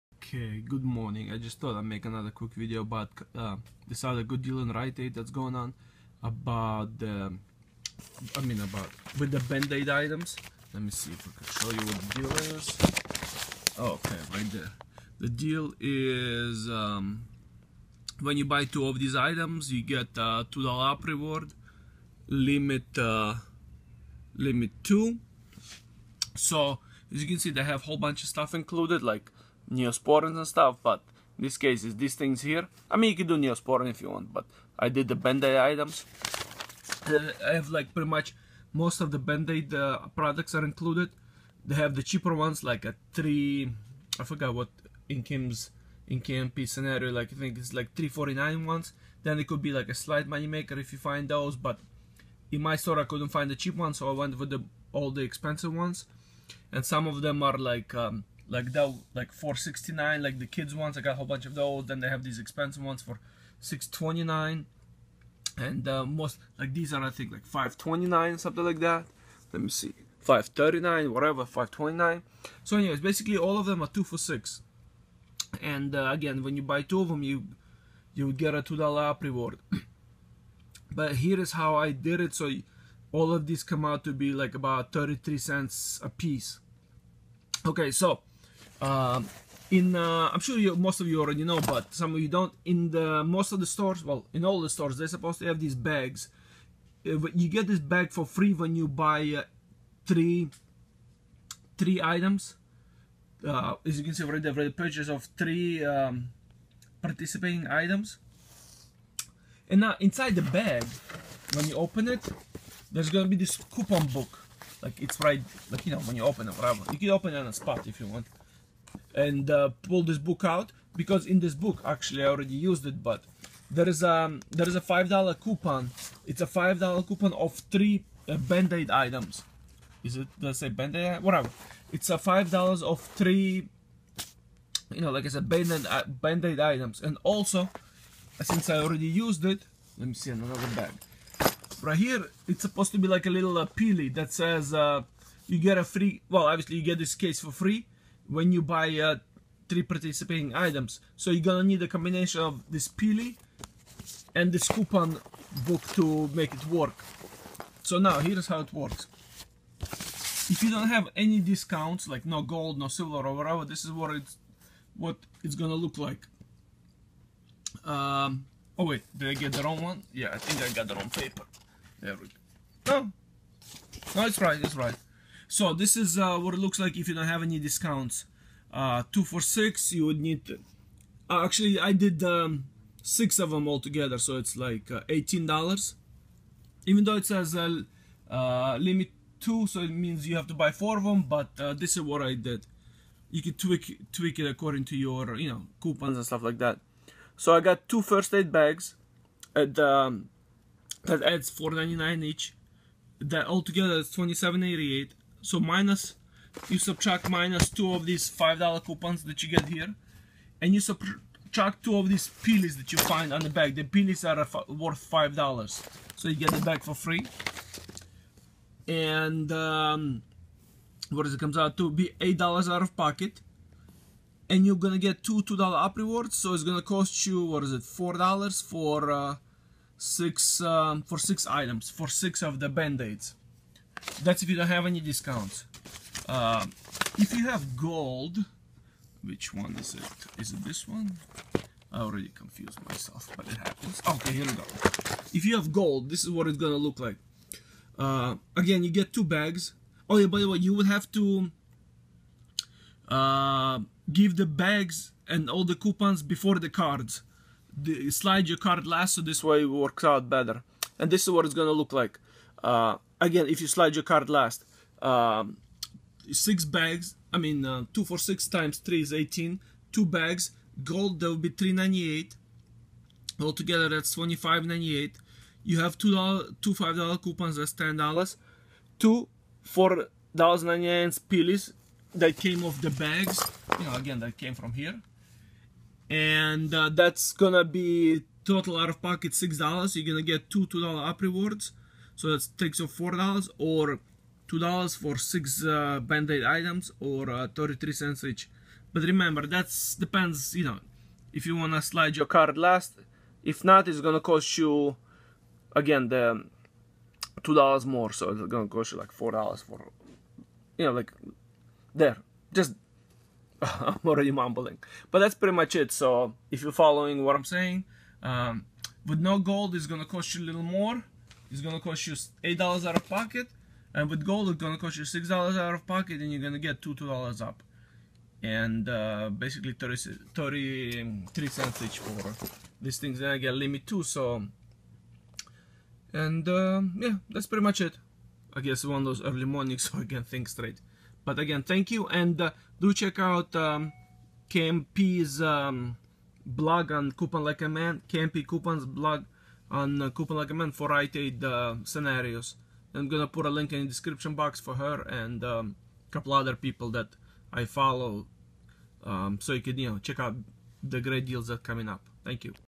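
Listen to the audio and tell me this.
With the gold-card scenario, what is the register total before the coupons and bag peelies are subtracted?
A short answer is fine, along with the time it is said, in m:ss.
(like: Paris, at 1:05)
25.98, at 4:34.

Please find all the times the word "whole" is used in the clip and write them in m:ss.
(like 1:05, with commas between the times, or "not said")
0:27, 1:01.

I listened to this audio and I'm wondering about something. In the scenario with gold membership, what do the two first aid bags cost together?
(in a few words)
3.98.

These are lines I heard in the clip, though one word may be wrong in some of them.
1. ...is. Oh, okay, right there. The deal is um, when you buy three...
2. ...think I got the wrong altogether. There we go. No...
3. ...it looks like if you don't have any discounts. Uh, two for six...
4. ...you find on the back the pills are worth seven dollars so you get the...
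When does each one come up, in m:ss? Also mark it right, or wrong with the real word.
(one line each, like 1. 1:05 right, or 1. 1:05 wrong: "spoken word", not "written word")
1. 0:12 wrong: "two", not "three"
2. 2:50 wrong: "paper", not "altogether"
3. 2:56 right
4. 3:32 wrong: "five", not "seven".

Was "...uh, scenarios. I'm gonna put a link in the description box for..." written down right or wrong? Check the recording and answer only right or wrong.
right.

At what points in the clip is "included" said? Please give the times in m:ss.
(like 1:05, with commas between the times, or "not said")
0:28, 0:40.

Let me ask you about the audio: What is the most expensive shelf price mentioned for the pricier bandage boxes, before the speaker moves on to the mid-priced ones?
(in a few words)
6.29.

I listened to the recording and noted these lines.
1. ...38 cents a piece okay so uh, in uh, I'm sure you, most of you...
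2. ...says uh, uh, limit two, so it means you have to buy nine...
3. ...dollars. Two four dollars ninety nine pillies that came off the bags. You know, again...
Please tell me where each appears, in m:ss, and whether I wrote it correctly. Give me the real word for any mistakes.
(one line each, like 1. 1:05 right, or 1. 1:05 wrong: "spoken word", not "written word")
1. 1:24 wrong: "33", not "38"
2. 3:07 wrong: "four", not "nine"
3. 4:37 right.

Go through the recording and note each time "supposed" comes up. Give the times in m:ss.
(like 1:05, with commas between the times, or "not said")
1:35, 2:22.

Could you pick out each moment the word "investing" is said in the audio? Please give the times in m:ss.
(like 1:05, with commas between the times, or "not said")
not said.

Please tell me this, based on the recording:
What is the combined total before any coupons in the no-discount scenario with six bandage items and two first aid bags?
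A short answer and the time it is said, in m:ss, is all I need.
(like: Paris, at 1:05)
27.88, at 3:24.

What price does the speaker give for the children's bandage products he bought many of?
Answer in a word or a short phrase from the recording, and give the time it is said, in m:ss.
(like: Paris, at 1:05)
4.69, at 0:59.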